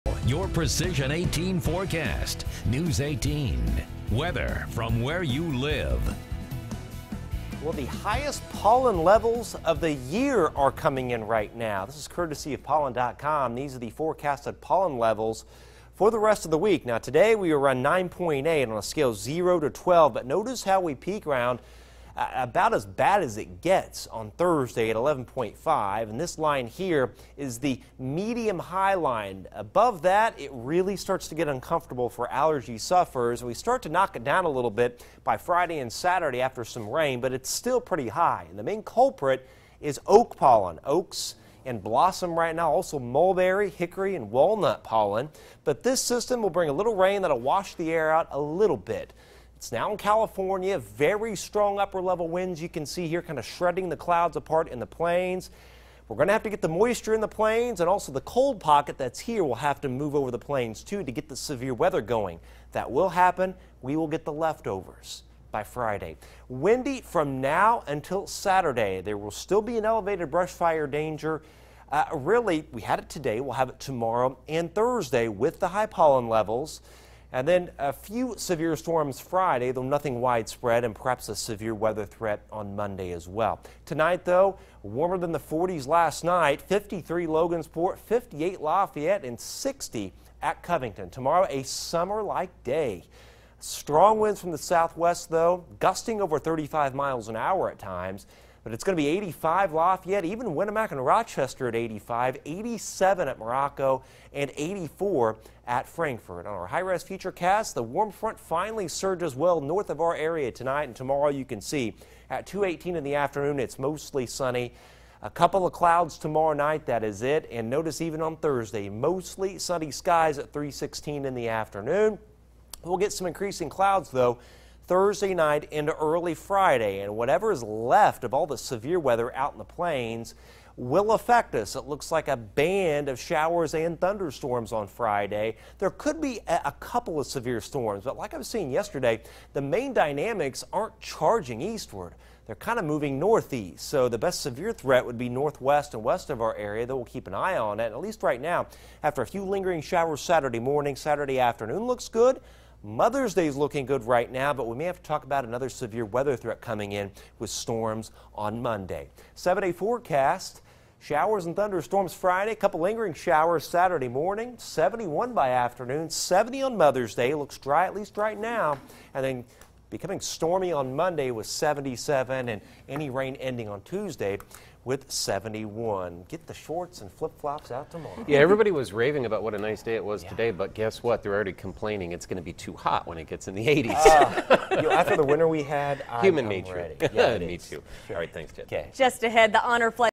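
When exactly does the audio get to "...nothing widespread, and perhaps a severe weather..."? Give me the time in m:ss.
1:19.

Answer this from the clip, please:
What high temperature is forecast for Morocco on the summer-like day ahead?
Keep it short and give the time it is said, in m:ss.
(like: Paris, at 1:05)
87, at 1:42.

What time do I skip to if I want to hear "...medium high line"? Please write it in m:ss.
0:27.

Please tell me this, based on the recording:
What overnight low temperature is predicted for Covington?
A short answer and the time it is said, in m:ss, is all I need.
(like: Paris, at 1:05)
60, at 1:29.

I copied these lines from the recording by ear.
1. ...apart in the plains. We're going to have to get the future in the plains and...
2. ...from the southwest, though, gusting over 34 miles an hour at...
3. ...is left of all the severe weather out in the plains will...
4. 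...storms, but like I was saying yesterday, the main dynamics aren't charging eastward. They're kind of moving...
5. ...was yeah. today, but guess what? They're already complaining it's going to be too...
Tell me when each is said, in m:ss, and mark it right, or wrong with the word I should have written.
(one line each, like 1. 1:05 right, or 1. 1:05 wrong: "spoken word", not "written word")
1. 0:54 wrong: "moisture", not "future"
2. 1:34 wrong: "35", not "34"
3. 2:07 right
4. 2:17 right
5. 3:00 right.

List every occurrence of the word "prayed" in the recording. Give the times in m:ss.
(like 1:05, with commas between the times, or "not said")
not said.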